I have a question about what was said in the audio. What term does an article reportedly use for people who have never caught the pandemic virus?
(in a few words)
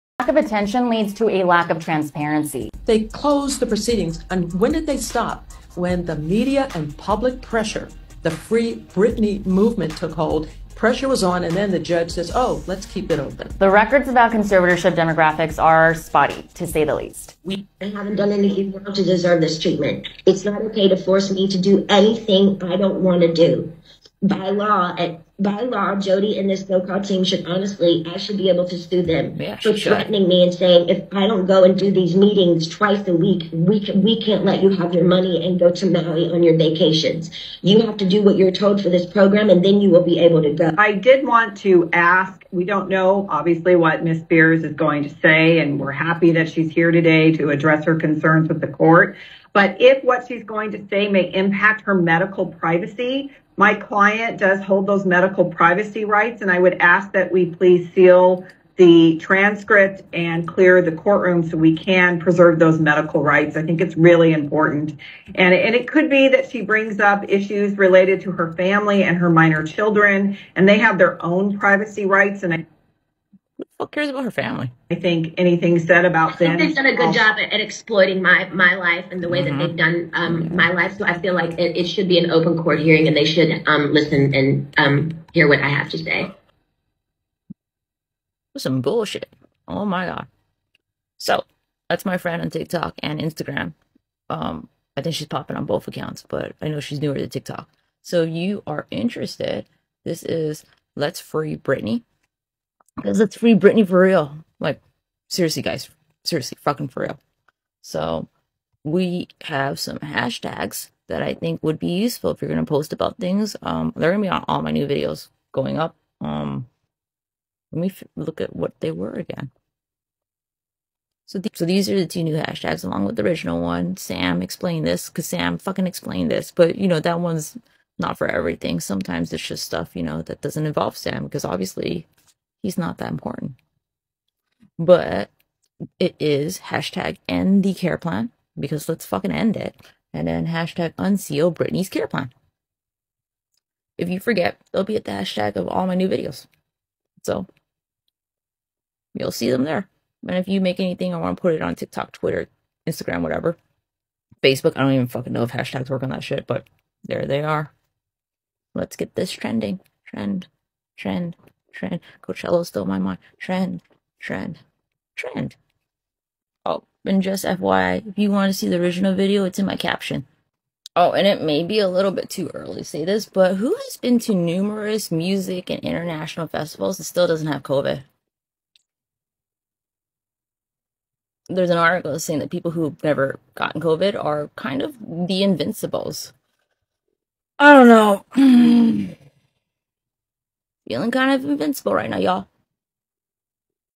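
the invincibles.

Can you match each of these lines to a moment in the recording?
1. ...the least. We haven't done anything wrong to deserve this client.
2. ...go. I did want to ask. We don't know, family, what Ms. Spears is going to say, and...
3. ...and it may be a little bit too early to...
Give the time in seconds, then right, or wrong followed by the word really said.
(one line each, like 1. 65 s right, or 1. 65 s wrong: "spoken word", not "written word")
1. 16 s wrong: "treatment", not "client"
2. 40 s wrong: "obviously", not "family"
3. 171 s right.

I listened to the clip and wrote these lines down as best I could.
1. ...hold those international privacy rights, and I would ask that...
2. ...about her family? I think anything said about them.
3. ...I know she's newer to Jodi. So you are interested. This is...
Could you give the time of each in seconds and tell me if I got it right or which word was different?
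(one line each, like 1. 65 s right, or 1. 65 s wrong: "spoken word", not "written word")
1. 54 s wrong: "medical", not "international"
2. 74 s right
3. 96 s wrong: "TikTok", not "Jodi".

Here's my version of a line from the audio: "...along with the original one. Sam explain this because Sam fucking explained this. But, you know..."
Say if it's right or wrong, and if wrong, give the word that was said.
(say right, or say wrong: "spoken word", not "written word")
right.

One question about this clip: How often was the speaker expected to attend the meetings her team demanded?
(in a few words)
twice a week.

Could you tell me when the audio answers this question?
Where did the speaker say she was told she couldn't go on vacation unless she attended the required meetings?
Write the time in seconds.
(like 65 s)
35 s.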